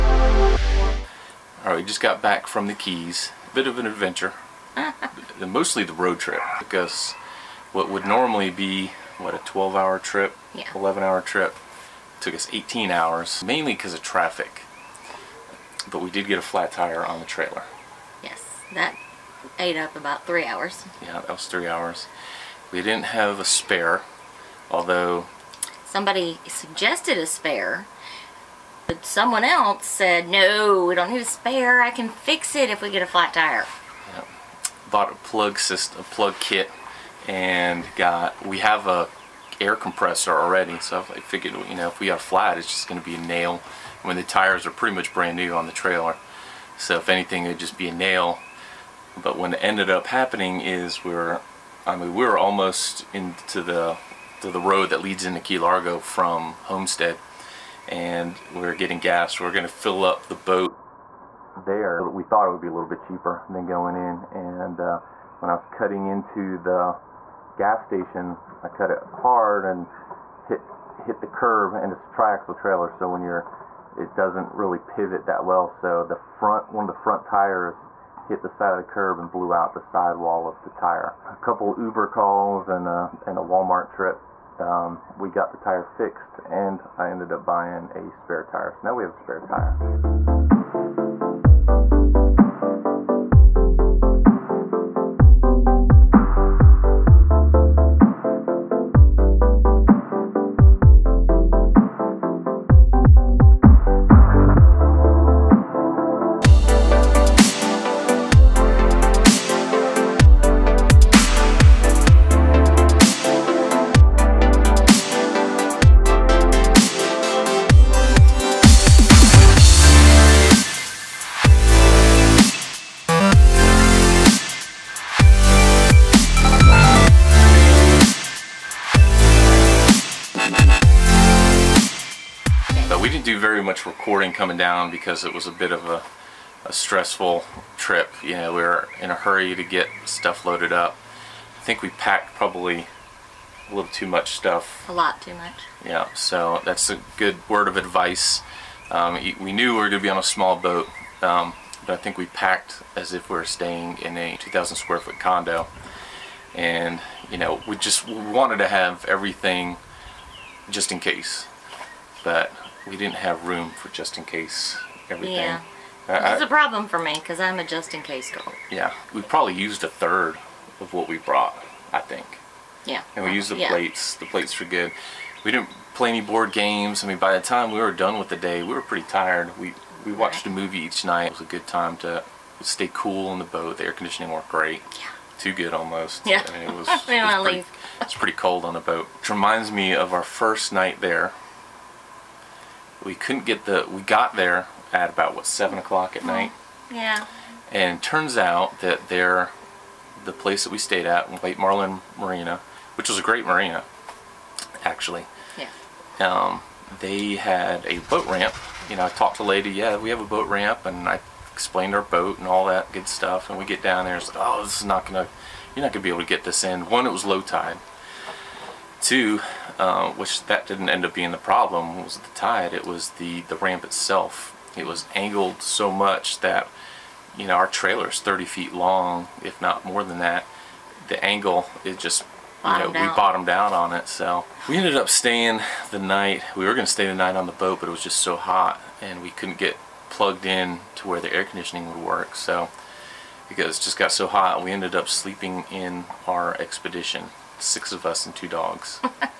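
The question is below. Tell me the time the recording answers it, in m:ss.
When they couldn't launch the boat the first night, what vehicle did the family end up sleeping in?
4:06.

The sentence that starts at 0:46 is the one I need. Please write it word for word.
So if anything, it'd just be a nail.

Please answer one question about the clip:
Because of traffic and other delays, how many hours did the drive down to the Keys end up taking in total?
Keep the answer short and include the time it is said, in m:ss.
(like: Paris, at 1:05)
18, at 0:12.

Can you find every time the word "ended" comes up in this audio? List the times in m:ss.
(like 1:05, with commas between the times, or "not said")
0:49, 1:27, 3:54, 4:04.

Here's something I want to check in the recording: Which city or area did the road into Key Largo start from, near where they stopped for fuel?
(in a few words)
Homestead.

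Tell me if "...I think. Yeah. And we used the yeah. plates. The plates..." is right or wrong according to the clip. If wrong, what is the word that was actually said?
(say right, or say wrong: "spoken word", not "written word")
right.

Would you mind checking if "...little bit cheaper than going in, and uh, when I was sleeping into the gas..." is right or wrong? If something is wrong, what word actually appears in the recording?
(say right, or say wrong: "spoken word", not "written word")
wrong: "cutting", not "sleeping".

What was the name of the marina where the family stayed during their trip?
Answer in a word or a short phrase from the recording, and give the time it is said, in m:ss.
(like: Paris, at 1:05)
White Marlin Marina, at 3:21.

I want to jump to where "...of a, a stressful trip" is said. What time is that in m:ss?
2:15.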